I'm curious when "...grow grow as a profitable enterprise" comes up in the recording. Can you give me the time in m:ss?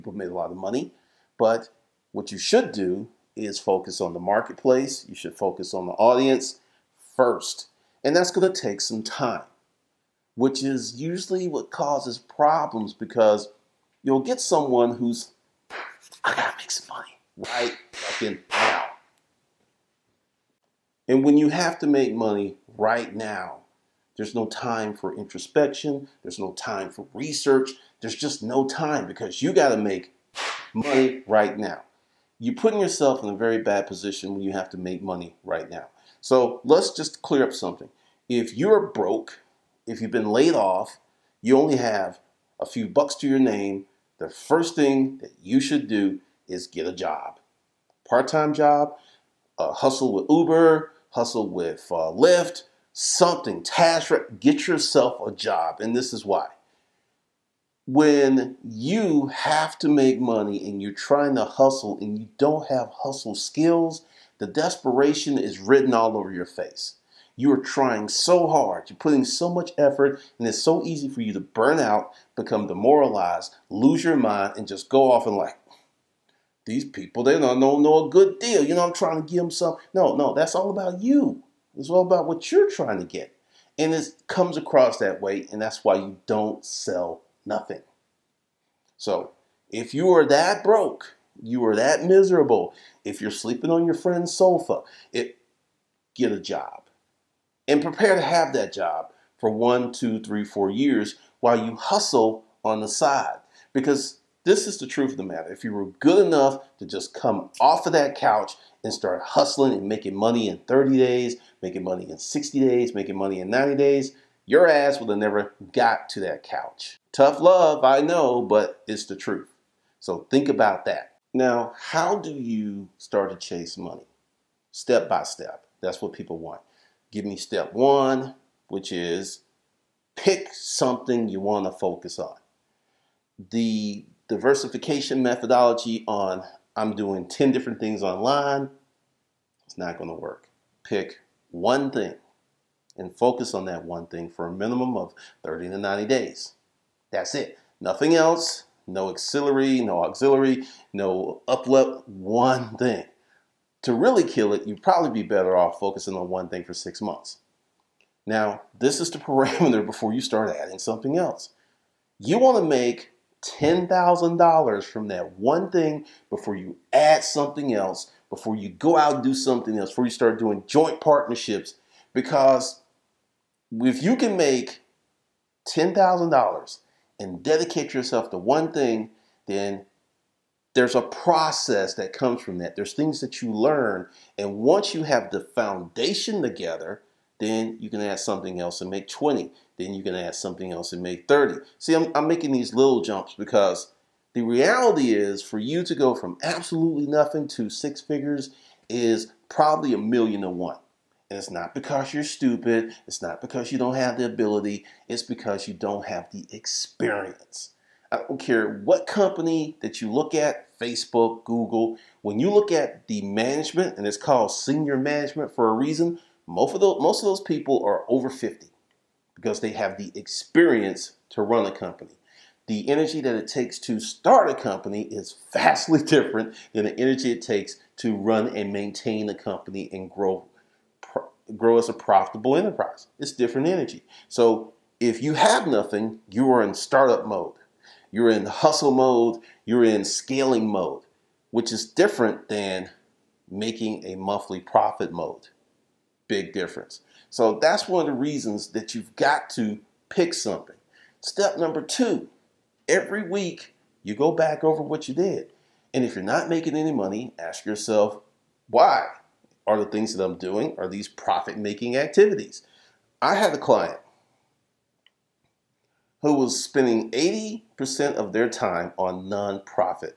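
3:50.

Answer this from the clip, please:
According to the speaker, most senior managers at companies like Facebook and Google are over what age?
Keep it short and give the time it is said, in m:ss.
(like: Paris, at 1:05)
50, at 3:38.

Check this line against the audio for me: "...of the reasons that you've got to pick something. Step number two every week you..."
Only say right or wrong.
right.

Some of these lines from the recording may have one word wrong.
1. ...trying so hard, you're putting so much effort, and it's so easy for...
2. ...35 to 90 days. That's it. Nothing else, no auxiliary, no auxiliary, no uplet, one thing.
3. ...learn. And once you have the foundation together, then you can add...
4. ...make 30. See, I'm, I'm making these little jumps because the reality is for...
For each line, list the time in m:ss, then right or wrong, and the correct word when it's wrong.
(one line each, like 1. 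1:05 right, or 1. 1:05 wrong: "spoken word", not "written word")
1. 1:07 right
2. 2:25 wrong: "30", not "35"
3. 3:03 right
4. 3:11 right.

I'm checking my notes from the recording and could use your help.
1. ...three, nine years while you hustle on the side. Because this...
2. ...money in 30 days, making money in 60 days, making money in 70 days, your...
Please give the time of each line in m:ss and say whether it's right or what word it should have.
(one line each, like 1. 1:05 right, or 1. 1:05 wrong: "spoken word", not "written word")
1. 1:40 wrong: "four", not "nine"
2. 1:50 wrong: "90", not "70".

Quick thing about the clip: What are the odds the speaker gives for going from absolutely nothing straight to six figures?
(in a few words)
a million to one.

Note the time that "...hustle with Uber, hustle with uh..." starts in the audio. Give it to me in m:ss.
0:49.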